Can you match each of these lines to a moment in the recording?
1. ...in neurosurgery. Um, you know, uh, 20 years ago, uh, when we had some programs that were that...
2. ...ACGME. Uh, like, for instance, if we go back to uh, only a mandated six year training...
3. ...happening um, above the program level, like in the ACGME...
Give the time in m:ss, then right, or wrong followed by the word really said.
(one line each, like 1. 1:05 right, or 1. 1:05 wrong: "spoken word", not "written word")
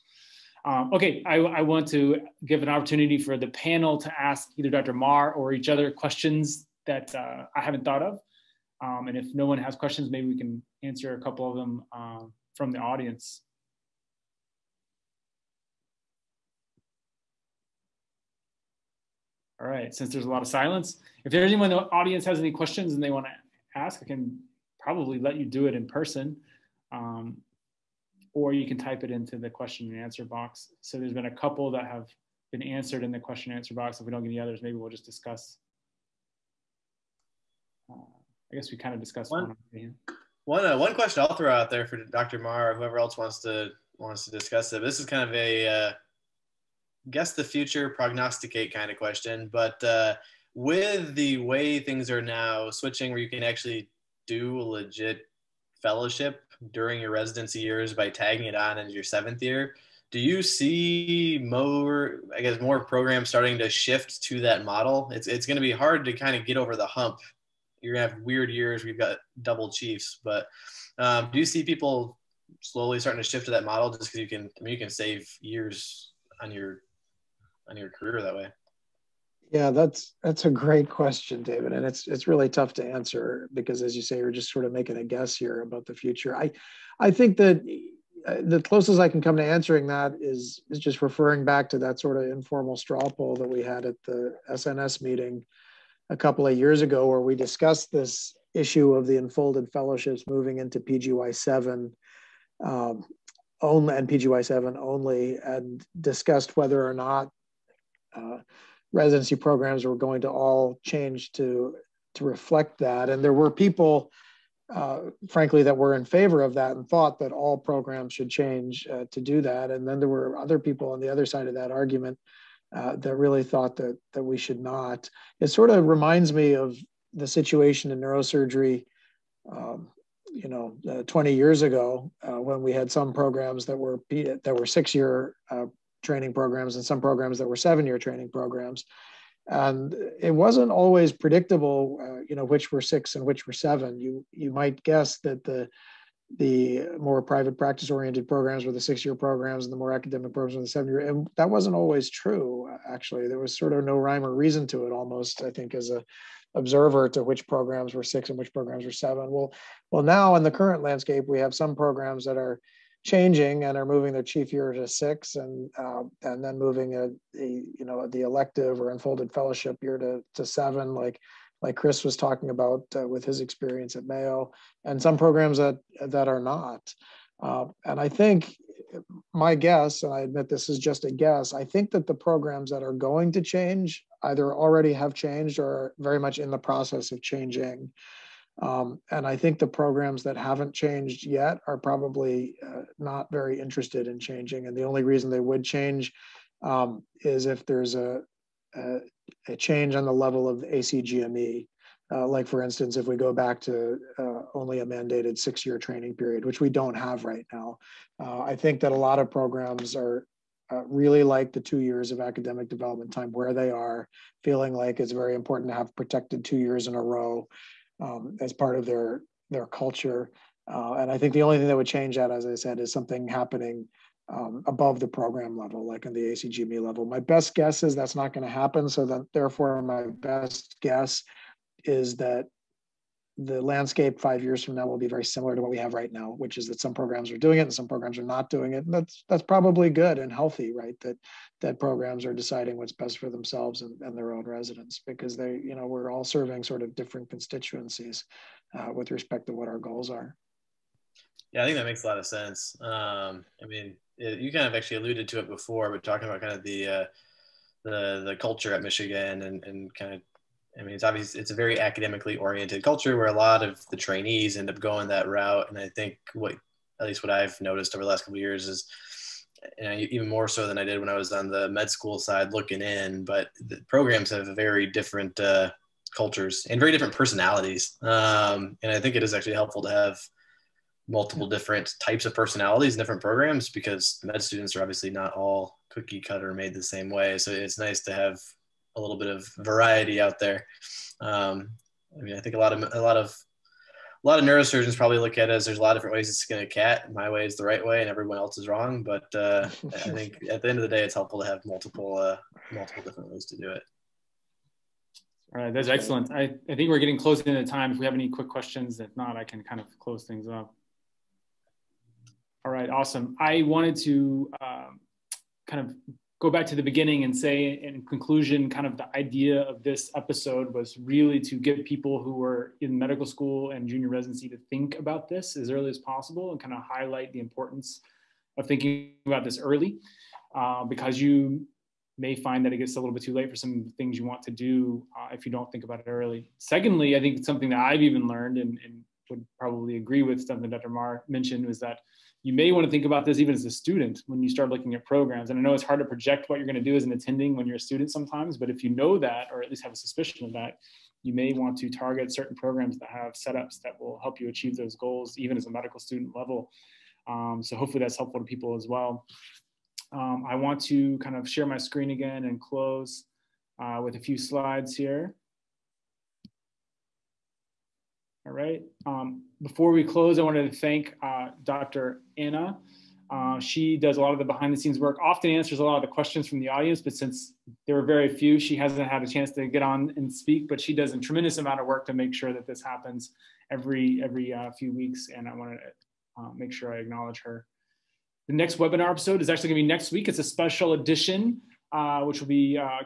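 1. 2:07 right
2. 3:20 right
3. 3:43 right.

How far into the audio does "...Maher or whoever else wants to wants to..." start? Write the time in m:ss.
0:42.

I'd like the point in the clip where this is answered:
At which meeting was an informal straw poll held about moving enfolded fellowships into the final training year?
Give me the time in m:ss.
1:34.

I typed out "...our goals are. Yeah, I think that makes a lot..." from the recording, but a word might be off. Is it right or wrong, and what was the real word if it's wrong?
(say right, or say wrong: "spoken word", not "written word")
right.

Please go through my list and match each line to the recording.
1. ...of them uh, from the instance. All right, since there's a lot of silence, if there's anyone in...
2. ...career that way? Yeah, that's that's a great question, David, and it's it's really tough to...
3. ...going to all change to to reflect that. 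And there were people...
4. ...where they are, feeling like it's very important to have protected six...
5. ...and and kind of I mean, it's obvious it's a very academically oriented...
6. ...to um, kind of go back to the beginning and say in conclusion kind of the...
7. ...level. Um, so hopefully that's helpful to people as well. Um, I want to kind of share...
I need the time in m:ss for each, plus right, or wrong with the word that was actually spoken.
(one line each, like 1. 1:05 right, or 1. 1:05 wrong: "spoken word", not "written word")
1. 0:11 wrong: "audience", not "instance"
2. 1:17 right
3. 1:49 right
4. 3:33 wrong: "two", not "six"
5. 4:19 right
6. 5:13 right
7. 5:56 right.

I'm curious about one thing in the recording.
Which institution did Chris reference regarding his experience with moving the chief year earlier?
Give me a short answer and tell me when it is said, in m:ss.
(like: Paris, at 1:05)
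Mayo, at 2:54.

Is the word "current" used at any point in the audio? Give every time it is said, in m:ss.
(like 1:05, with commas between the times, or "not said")
2:40.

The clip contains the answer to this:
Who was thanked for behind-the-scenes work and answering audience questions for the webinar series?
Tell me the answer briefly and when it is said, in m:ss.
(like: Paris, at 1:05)
Dr. Anna, at 6:11.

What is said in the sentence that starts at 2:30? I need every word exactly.
And that wasn't always true, actually.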